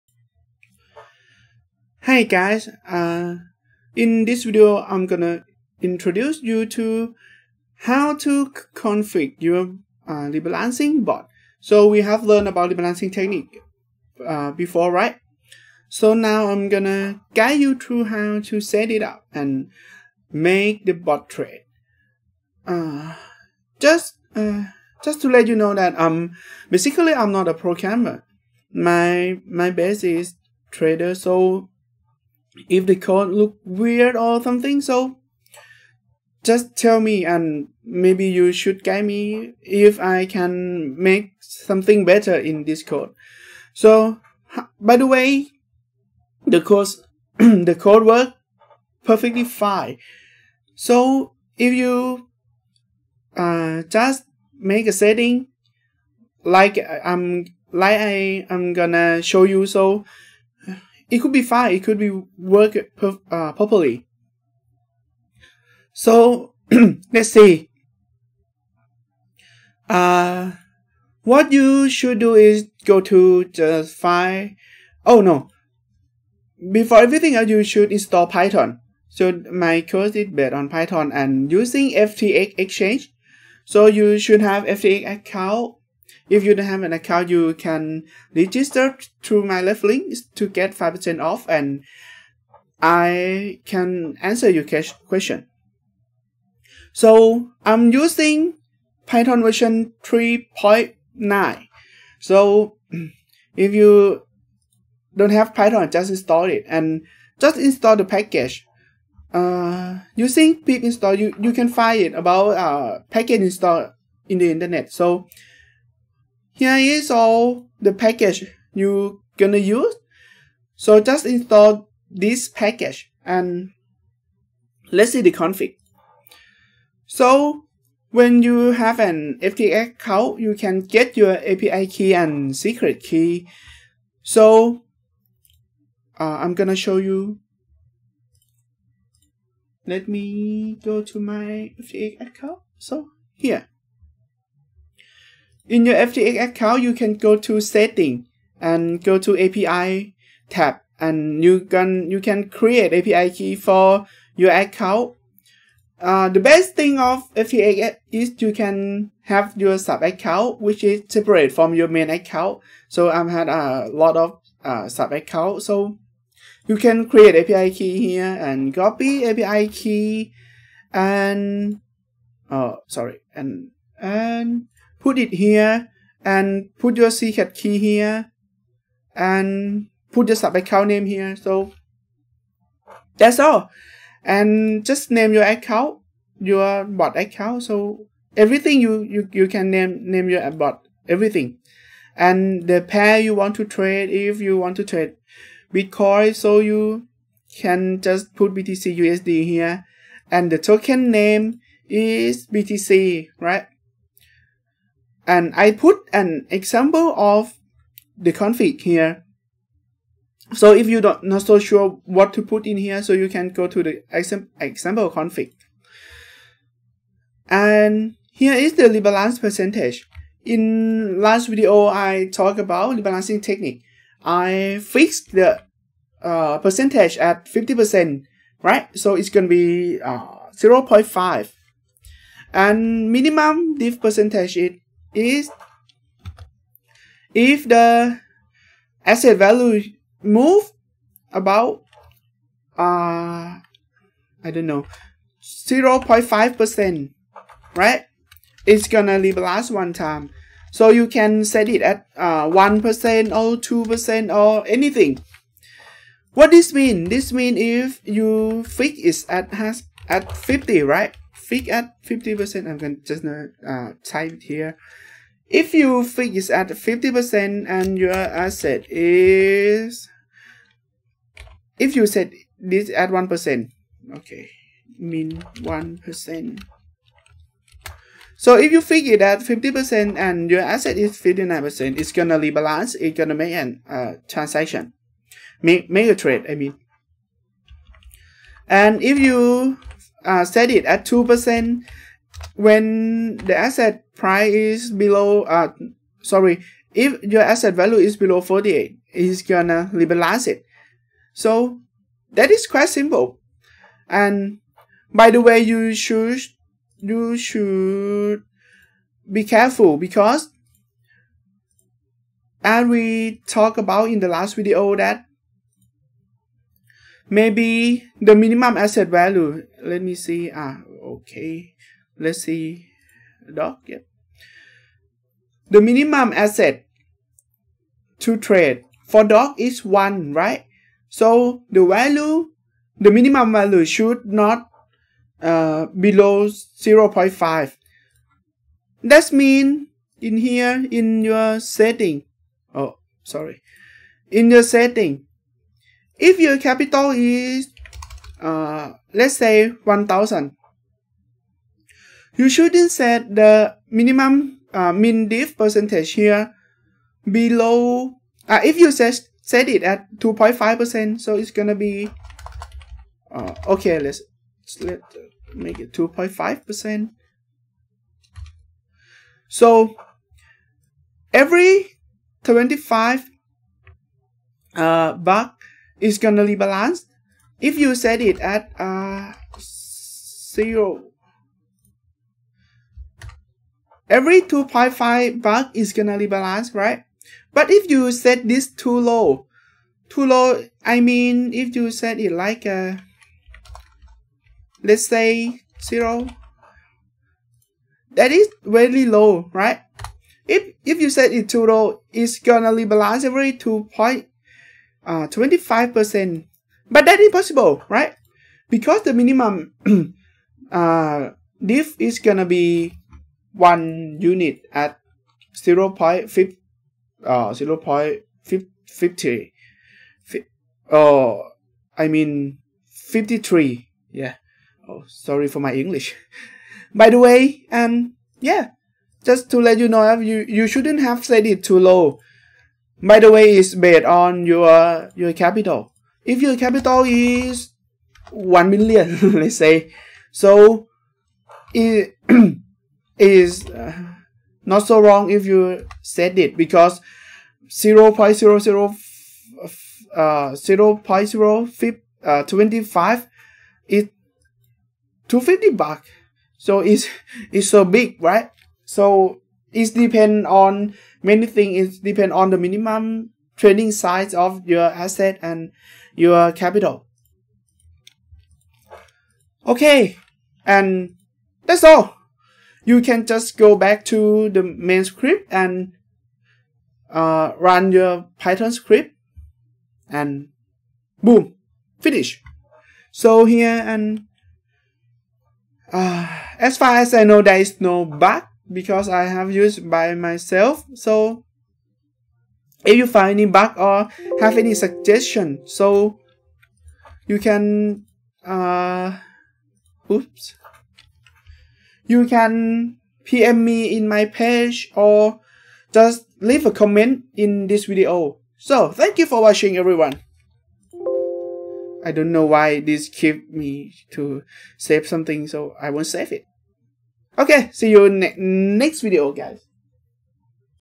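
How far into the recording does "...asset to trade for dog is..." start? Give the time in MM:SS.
05:26.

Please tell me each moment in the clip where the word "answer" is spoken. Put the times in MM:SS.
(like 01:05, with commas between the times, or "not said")
01:34.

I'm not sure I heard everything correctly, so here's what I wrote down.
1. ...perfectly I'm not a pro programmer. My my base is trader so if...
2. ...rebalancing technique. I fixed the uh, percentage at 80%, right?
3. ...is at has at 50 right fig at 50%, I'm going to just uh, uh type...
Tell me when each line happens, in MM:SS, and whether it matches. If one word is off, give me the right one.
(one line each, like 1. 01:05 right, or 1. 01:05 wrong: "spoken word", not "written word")
1. 00:26 wrong: "basically", not "perfectly"
2. 03:42 wrong: "50", not "80"
3. 04:18 right.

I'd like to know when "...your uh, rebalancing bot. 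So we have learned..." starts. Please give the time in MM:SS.
00:09.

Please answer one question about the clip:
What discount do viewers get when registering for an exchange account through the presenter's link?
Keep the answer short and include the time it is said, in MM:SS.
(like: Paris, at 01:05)
5%, at 01:30.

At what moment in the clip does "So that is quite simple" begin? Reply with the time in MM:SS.
05:01.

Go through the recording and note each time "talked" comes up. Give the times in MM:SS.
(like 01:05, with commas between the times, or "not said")
03:42, 05:13.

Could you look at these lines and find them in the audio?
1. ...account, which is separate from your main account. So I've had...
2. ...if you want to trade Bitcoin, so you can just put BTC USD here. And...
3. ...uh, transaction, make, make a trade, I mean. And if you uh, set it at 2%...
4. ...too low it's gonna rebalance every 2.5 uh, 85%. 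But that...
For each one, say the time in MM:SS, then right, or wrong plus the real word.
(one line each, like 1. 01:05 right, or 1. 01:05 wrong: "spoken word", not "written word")
1. 02:40 right
2. 03:14 right
3. 04:43 right
4. 06:41 wrong: "25", not "85".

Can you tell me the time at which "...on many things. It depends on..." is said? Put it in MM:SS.
07:40.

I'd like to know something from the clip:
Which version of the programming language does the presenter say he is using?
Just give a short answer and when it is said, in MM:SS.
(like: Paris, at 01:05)
3.9, at 01:39.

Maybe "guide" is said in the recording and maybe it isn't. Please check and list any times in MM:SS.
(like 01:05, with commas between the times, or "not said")
00:17, 00:38.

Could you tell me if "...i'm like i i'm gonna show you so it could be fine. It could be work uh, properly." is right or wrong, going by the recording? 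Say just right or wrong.
right.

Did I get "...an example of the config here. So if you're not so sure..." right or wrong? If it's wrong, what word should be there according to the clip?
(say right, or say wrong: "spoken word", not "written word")
right.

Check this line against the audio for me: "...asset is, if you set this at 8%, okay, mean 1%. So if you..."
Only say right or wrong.
wrong.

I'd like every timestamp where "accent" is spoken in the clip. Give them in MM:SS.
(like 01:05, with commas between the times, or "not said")
not said.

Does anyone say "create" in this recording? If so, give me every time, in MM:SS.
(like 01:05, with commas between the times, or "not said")
02:32, 02:47.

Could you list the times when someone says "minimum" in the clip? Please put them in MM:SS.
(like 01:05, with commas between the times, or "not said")
03:53, 05:18, 05:25, 05:33, 05:53, 06:49, 07:42.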